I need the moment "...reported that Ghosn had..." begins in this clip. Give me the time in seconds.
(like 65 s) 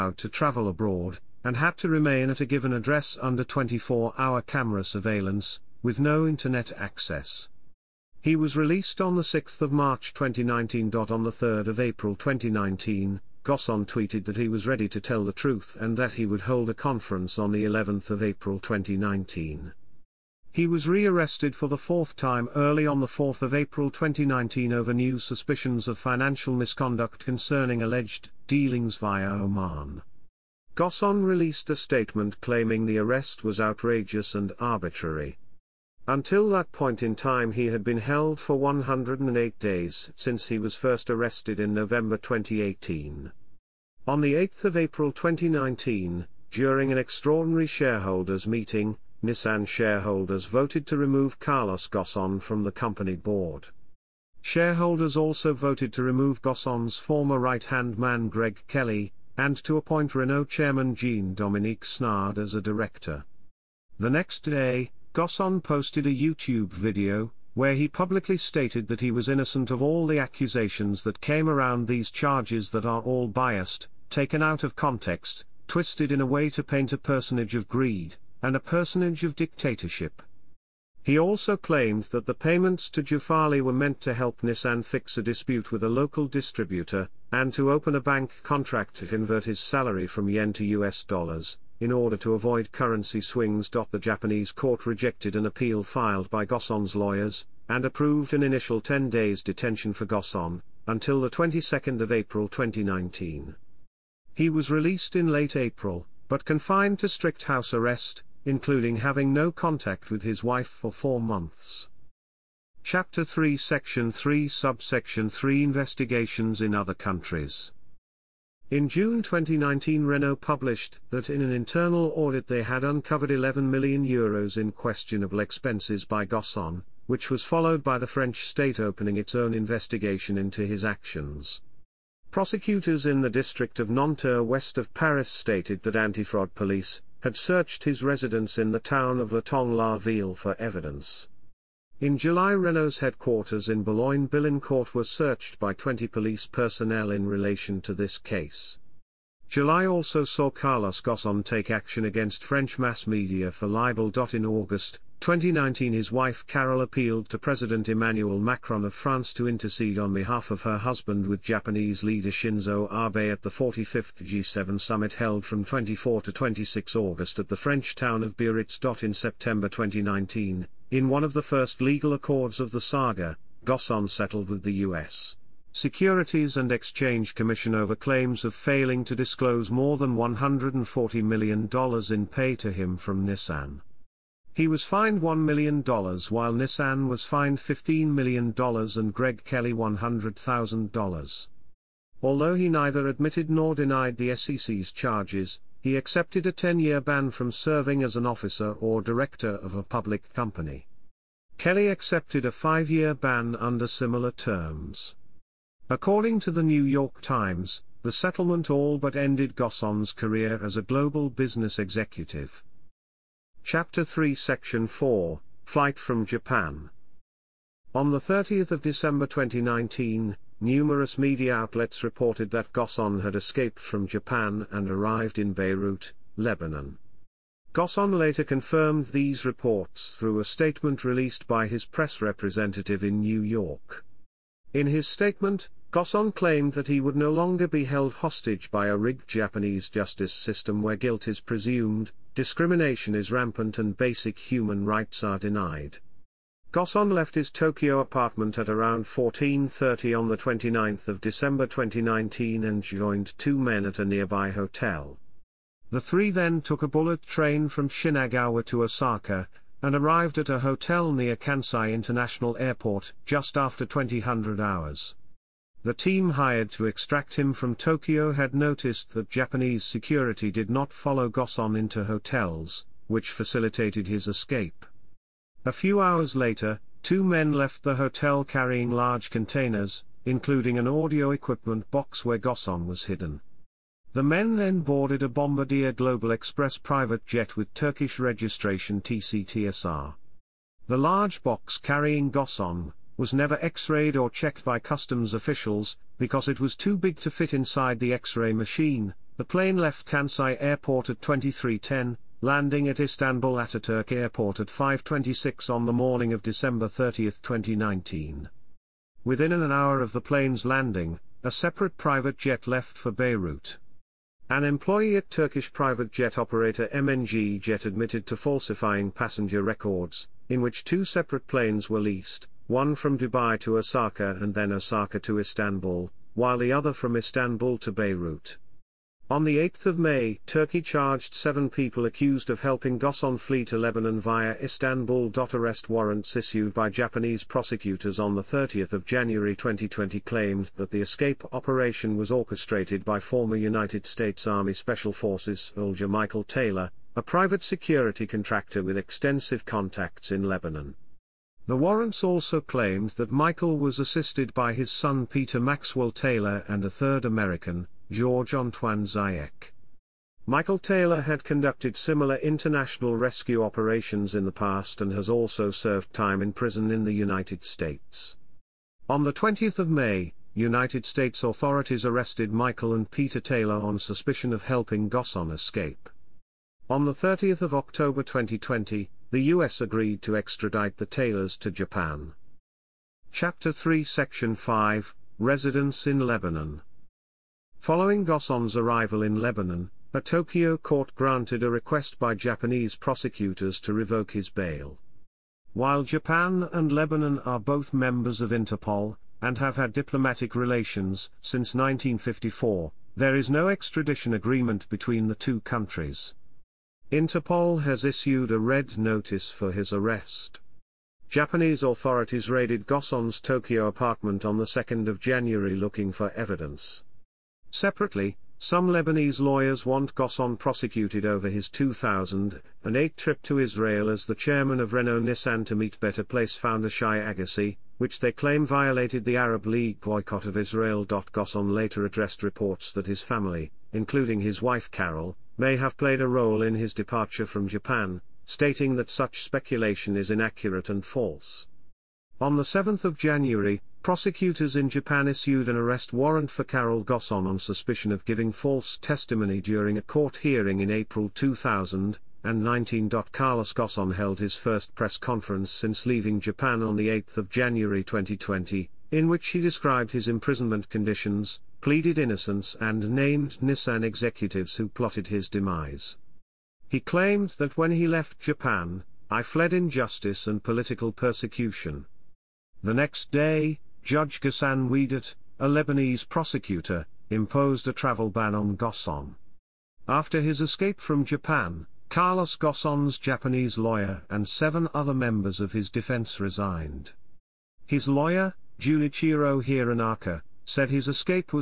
222 s.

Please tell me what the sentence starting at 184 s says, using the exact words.
He was fined $1 million while Nissan was fined $15 million and Greg Kelly $100,000.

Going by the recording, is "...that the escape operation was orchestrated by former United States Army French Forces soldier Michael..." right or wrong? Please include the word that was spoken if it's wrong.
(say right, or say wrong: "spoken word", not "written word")
wrong: "Special", not "French".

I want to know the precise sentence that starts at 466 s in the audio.
He claimed that when he left Japan, I fled injustice and political persecution.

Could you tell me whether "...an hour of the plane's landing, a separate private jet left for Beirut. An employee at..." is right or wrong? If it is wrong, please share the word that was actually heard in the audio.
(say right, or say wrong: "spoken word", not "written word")
right.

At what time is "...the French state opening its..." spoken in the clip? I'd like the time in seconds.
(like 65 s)
127 s.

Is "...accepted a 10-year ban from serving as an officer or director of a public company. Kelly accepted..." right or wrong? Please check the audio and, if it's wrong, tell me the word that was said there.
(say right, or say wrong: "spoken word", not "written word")
right.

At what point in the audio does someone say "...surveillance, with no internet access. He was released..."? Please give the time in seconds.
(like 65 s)
4 s.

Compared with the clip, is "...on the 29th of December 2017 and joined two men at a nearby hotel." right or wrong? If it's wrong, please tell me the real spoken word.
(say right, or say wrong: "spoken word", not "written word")
wrong: "2019", not "2017".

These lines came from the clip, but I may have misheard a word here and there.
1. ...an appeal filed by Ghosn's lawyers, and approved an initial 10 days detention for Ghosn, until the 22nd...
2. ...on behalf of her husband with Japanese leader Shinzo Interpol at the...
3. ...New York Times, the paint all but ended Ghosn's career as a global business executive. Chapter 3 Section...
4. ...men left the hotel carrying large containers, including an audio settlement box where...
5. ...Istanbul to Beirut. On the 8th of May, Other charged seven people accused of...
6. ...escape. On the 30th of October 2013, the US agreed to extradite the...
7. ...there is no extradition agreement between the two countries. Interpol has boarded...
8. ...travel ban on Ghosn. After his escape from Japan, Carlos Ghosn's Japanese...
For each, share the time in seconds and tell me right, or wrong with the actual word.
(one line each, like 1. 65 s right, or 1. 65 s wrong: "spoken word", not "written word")
1. 95 s right
2. 159 s wrong: "Abe", not "Interpol"
3. 206 s wrong: "settlement", not "paint"
4. 277 s wrong: "equipment", not "settlement"
5. 327 s wrong: "Turkey", not "Other"
6. 375 s wrong: "2020", not "2013"
7. 403 s wrong: "issued", not "boarded"
8. 477 s right.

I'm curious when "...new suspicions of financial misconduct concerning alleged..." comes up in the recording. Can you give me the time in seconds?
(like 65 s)
24 s.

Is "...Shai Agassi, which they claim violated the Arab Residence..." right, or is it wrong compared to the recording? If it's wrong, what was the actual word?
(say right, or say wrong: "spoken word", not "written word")
wrong: "League", not "Residence".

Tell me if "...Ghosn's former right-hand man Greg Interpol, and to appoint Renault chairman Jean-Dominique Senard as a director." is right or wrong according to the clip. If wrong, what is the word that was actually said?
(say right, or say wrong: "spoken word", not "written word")
wrong: "Kelly", not "Interpol".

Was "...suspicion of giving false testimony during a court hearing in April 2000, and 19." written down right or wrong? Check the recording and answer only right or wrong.
right.